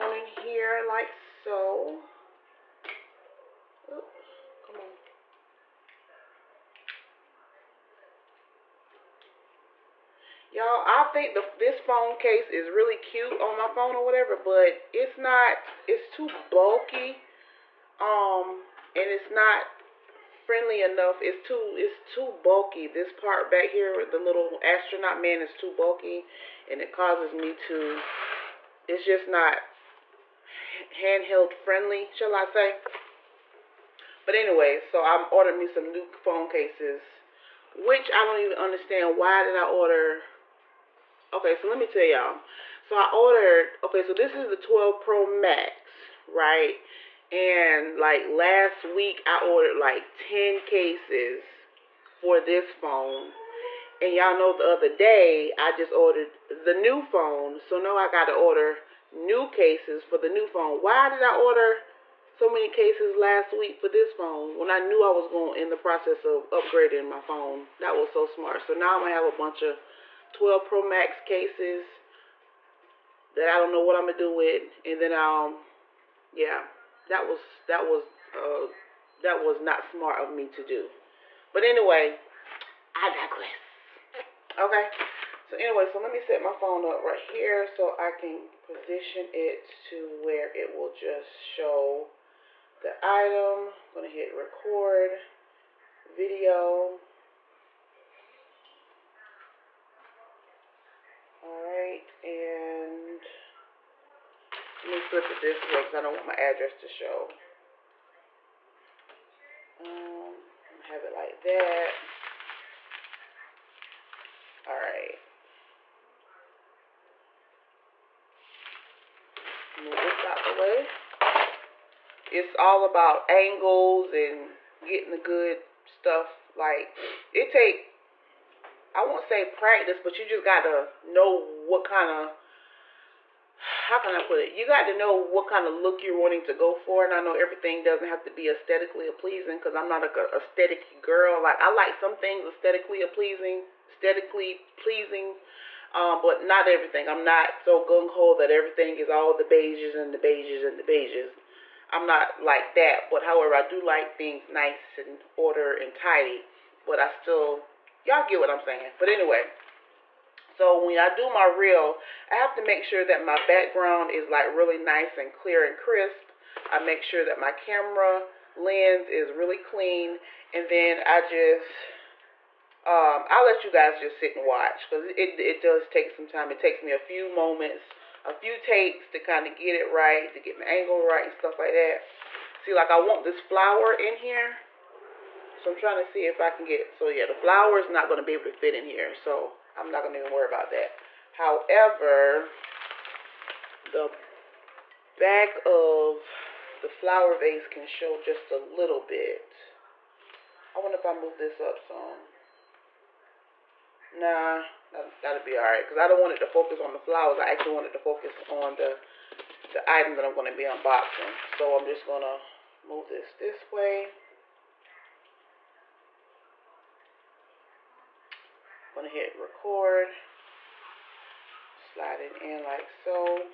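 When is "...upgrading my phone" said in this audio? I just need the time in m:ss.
1:06.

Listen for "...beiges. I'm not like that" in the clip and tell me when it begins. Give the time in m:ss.
2:30.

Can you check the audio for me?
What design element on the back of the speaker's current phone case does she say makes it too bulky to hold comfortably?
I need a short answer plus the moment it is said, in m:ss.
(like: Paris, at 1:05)
Astronaut, at 0:24.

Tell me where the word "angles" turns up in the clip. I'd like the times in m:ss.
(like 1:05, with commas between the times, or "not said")
2:03, 3:00.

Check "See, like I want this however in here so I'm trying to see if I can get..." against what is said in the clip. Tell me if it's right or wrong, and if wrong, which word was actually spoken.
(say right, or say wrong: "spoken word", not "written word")
wrong: "flower", not "however".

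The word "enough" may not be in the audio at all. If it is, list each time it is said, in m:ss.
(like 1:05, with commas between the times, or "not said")
0:20.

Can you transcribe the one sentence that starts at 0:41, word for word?
Okay, so let me tell y'all.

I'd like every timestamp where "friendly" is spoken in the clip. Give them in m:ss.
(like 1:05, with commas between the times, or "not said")
0:20, 0:31.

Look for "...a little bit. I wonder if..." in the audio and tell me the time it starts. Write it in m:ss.
3:18.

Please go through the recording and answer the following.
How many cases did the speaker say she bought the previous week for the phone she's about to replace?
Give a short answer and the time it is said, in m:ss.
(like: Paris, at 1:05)
10, at 0:50.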